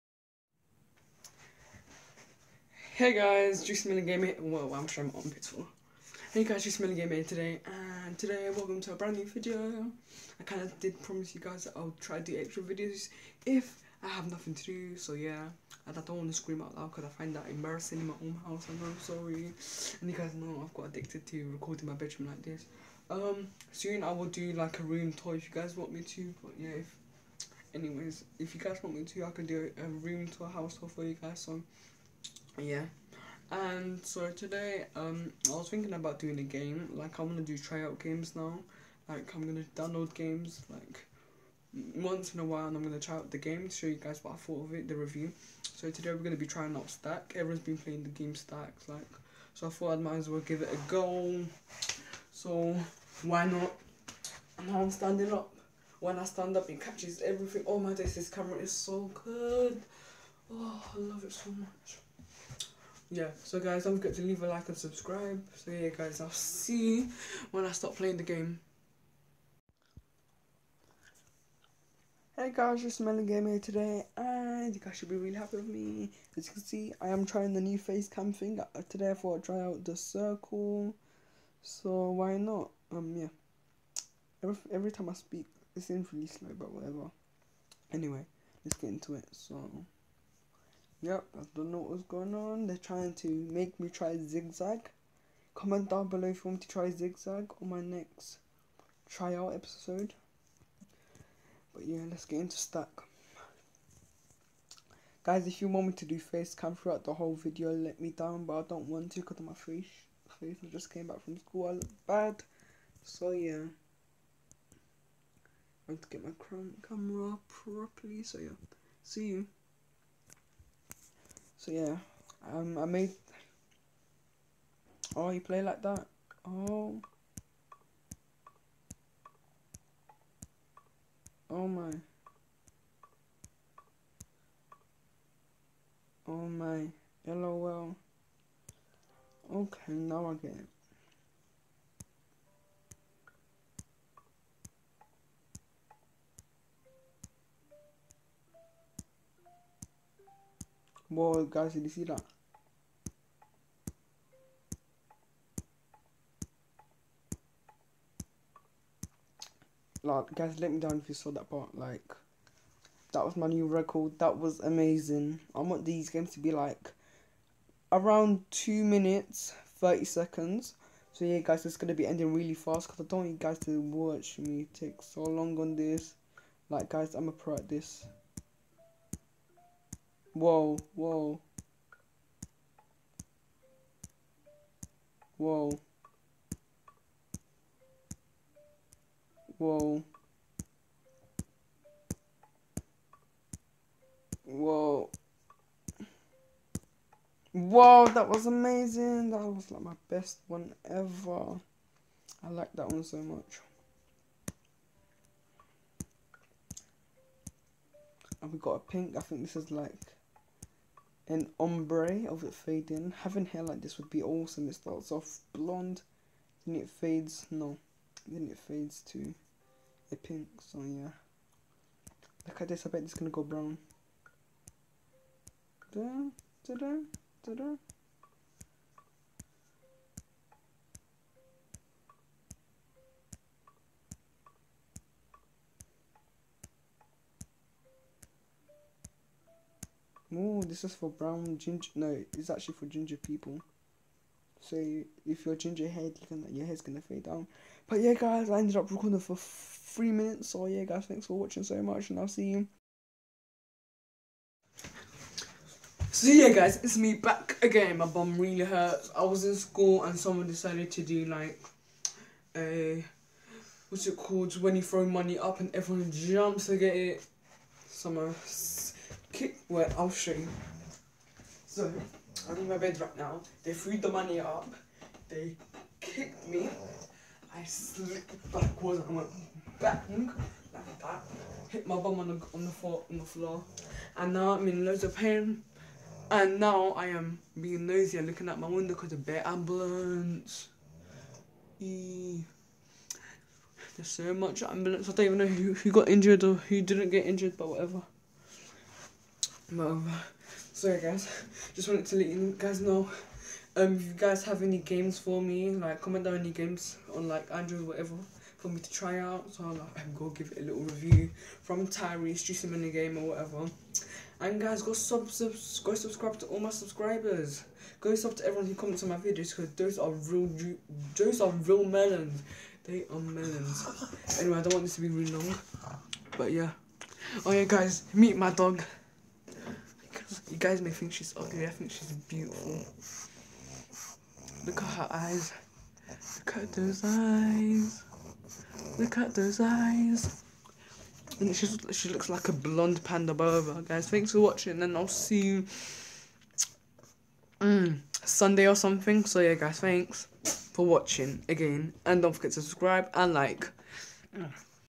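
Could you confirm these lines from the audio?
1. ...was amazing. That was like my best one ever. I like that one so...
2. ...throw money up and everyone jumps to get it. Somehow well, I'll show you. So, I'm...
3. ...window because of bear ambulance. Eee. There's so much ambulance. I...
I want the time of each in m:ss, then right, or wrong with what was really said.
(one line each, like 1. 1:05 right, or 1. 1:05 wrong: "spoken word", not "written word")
1. 3:18 right
2. 4:24 right
3. 4:48 right.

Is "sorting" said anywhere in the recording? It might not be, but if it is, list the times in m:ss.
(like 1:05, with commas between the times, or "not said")
not said.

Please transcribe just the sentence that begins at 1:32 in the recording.
They're trying to make me try zigzag.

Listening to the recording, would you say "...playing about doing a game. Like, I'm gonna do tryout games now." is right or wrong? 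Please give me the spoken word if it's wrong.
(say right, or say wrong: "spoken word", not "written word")
wrong: "thinking", not "playing".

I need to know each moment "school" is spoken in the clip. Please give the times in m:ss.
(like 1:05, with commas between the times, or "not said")
1:51, 4:19.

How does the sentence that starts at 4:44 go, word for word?
And now I'm in loads of pain.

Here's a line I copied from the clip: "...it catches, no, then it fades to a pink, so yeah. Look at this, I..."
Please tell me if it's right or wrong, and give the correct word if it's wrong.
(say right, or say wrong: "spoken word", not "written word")
wrong: "fades", not "catches".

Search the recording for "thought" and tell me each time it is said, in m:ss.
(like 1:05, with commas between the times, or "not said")
0:44, 0:49, 1:19.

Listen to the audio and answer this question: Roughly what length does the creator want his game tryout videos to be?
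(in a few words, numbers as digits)
2 minutes 30 seconds.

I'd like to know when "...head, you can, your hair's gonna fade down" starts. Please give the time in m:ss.
4:05.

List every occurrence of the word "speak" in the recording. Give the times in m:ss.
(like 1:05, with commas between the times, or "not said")
1:25.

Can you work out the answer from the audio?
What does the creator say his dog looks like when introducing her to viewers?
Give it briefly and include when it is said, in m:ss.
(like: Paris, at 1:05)
a blonde panda, at 5:42.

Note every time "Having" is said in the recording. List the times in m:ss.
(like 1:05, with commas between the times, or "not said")
3:33.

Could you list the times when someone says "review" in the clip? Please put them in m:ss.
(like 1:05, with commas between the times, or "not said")
0:44, 5:10.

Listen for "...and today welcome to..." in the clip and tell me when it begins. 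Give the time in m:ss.
0:08.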